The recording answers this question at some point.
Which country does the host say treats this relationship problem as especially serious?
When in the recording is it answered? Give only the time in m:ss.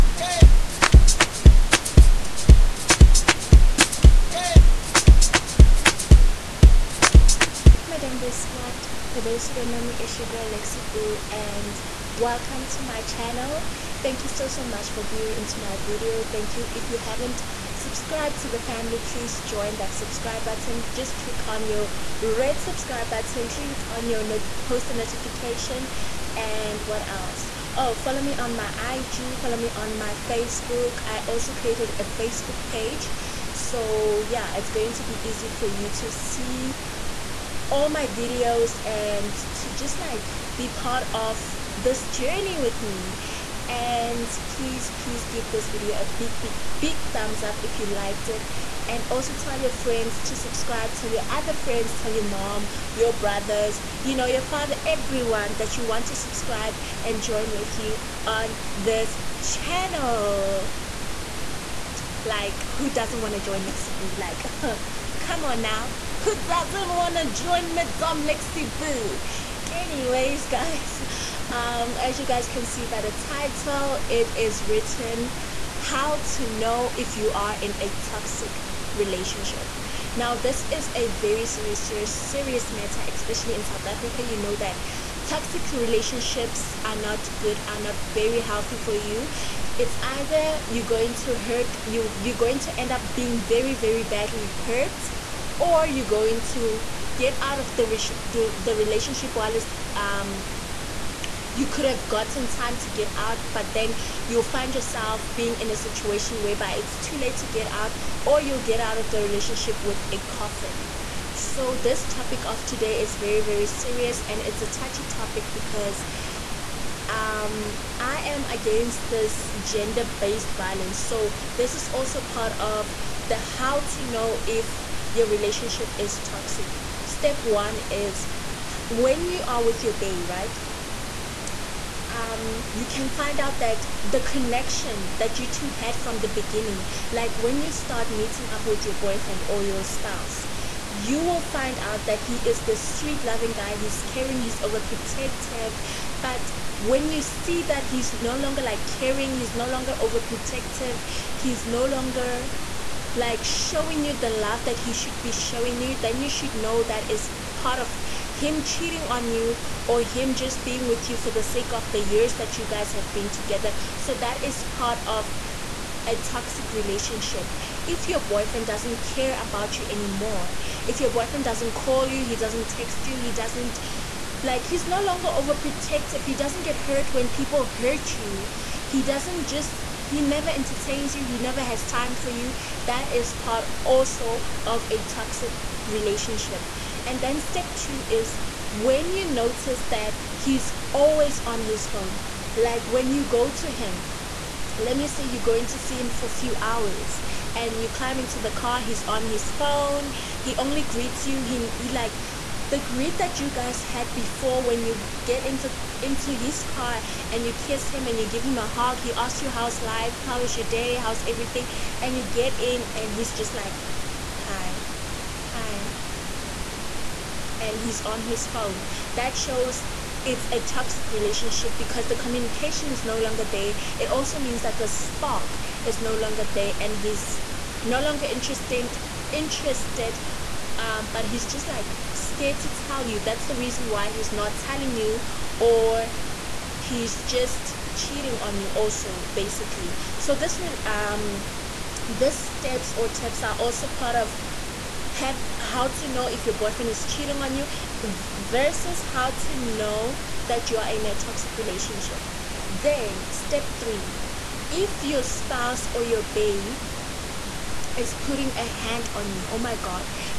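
1:23.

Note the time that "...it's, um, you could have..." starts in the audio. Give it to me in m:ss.
1:39.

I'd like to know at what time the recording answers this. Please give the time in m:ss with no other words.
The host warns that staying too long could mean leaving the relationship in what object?
1:50.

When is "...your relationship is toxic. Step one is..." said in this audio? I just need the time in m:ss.
2:05.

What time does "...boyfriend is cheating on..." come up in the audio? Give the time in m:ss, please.
4:06.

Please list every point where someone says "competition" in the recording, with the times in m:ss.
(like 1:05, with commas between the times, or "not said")
not said.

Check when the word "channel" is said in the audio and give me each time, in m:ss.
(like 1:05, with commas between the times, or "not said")
0:13, 0:59.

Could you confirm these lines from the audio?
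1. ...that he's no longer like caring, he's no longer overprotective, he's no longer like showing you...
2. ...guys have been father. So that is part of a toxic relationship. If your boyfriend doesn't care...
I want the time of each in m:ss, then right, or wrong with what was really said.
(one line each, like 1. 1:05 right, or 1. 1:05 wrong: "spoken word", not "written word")
1. 2:27 right
2. 2:42 wrong: "together", not "father".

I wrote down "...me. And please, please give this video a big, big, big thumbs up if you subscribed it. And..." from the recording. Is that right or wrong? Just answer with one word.
wrong.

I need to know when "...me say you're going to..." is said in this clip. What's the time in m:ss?
3:14.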